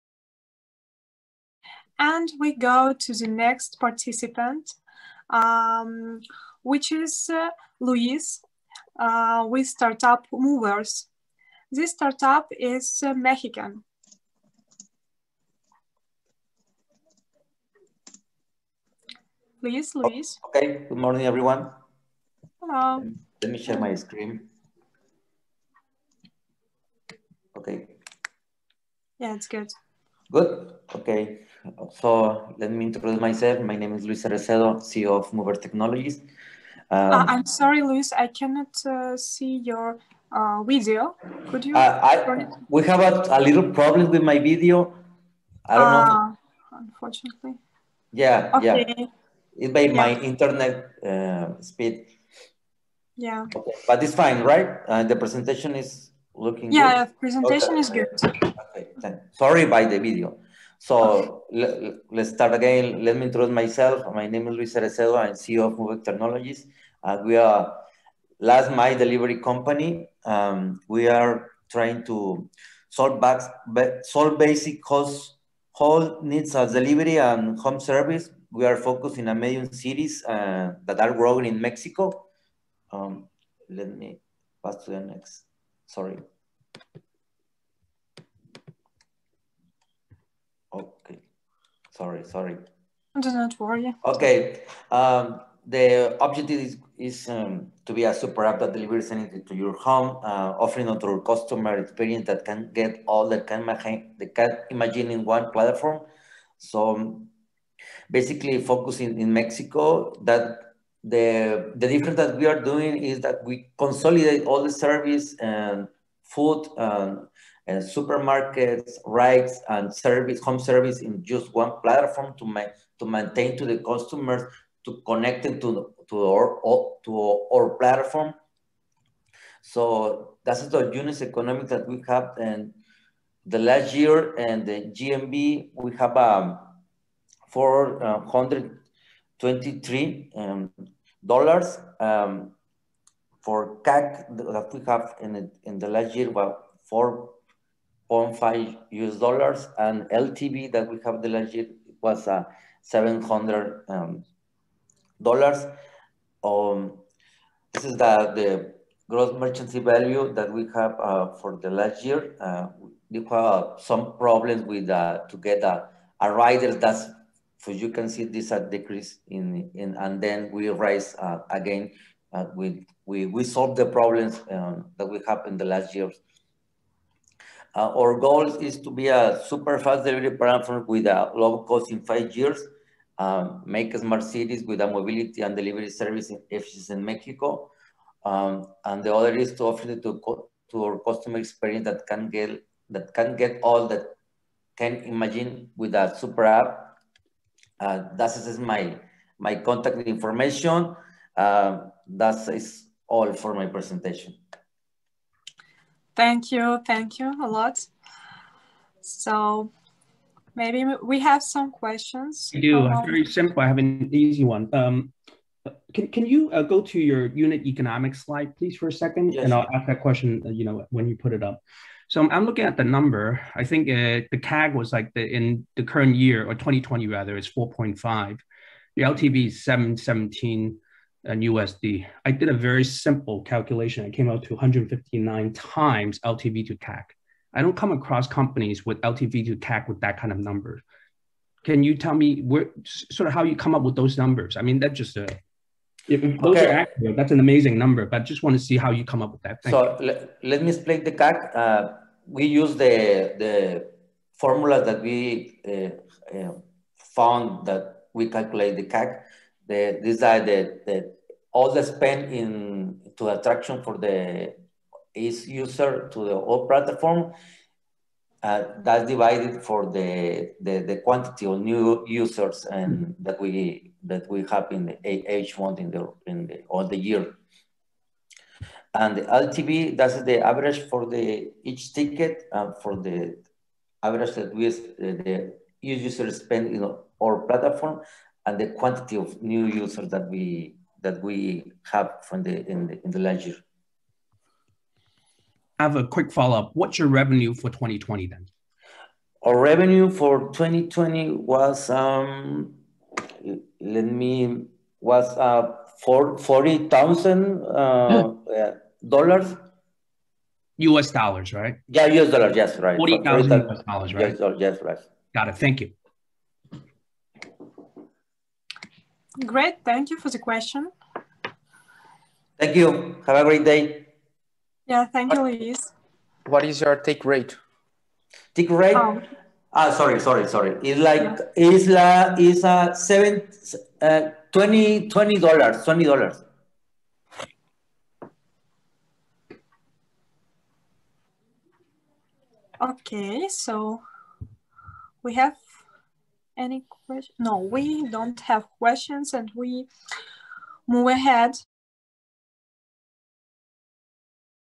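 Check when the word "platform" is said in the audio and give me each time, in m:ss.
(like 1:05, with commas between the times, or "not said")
1:45, 2:01, 2:07, 3:00, 4:26, 4:47.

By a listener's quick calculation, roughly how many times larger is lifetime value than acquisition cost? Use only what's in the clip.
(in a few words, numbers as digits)
159 times.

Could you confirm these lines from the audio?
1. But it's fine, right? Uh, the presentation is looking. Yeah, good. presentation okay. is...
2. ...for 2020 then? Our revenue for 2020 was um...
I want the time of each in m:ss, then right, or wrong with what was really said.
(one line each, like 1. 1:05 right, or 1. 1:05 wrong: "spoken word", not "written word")
1. 0:53 right
2. 4:57 right.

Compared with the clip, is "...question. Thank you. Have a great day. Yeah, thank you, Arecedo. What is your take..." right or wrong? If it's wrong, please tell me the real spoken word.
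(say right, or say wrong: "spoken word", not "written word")
wrong: "Luis", not "Arecedo".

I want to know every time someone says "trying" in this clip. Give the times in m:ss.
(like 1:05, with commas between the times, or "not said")
1:11.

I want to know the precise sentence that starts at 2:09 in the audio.
So that's the unit economic that we have.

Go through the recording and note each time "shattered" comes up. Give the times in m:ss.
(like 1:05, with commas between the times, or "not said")
not said.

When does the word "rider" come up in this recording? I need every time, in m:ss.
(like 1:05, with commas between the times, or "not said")
2:46.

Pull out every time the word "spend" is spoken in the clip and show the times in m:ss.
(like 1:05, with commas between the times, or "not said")
4:21, 4:46.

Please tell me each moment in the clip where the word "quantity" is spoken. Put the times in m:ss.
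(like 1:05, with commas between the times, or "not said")
4:31, 4:48.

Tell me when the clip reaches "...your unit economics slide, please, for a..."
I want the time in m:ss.
3:36.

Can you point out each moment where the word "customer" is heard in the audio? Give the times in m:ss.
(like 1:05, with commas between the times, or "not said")
1:41, 2:03, 3:10.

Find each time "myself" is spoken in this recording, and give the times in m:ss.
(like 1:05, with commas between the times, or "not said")
0:33, 1:03.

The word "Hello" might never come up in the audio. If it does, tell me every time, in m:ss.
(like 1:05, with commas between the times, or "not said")
0:22.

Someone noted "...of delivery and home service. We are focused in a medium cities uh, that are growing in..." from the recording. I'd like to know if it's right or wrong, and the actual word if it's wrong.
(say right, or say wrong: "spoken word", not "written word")
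right.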